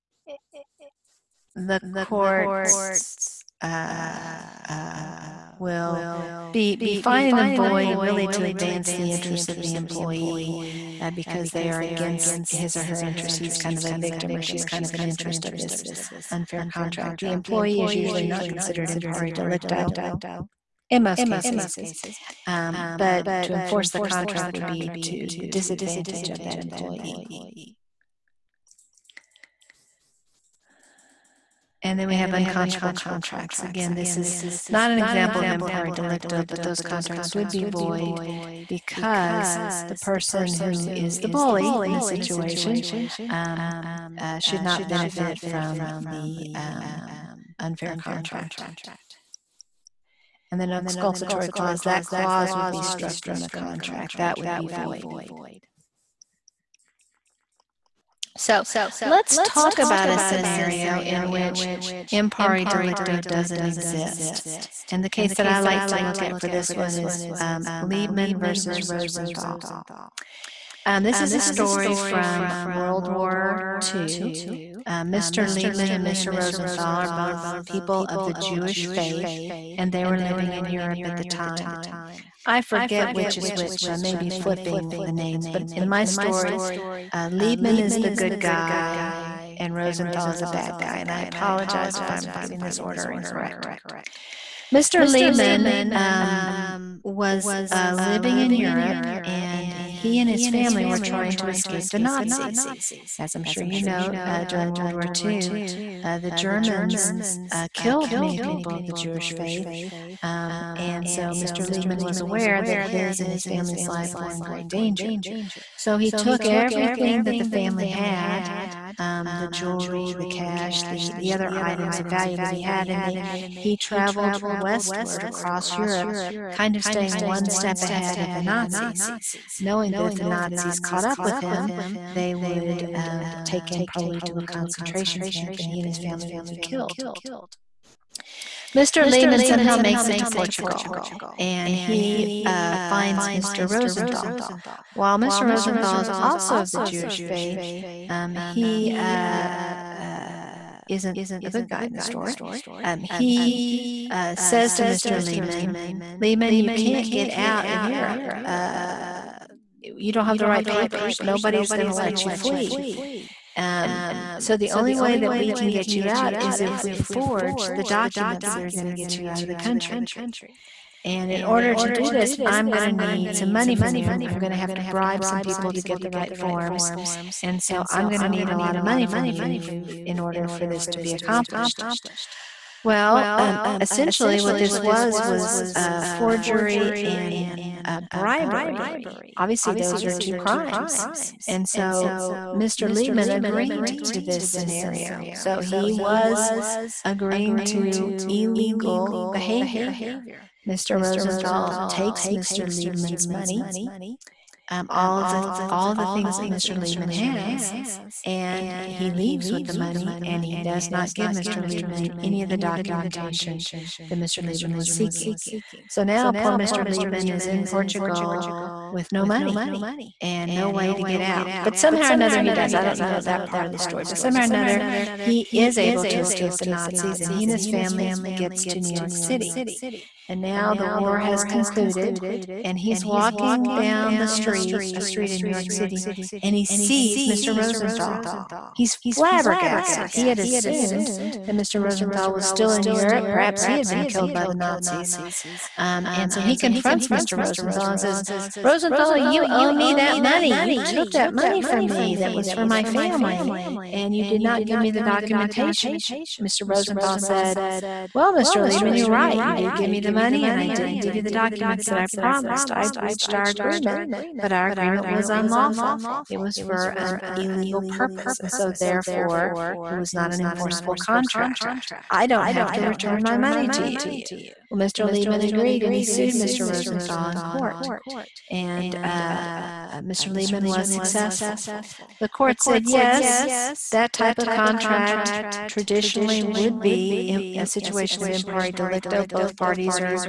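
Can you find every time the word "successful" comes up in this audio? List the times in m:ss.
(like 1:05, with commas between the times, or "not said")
4:40.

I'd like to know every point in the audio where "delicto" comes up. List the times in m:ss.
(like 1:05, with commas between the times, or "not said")
0:19, 0:35, 1:02, 4:48.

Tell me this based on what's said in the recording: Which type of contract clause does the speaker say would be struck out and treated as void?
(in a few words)
Exculpatory clause.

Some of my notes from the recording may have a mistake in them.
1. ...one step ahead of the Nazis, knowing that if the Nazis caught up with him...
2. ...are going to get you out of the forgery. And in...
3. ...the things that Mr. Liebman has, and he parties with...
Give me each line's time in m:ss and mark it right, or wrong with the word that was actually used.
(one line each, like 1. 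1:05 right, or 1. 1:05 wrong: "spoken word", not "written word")
1. 2:07 right
2. 2:48 wrong: "country", not "forgery"
3. 3:25 wrong: "leaves", not "parties".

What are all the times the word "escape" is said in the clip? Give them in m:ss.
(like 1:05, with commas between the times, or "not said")
1:41, 3:46.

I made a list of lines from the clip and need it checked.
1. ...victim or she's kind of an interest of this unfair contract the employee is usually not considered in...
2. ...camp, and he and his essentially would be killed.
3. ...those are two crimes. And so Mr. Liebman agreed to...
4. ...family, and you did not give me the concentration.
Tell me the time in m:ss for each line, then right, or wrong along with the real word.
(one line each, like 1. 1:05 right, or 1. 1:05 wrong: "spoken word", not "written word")
1. 0:13 right
2. 2:15 wrong: "family", not "essentially"
3. 3:09 right
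4. 4:12 wrong: "documentation", not "concentration".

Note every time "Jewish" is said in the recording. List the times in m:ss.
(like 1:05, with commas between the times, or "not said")
1:18, 1:48, 2:26.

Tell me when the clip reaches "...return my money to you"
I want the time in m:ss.
4:32.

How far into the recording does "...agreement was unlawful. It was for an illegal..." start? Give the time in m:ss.
4:24.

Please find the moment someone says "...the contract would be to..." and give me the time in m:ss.
0:23.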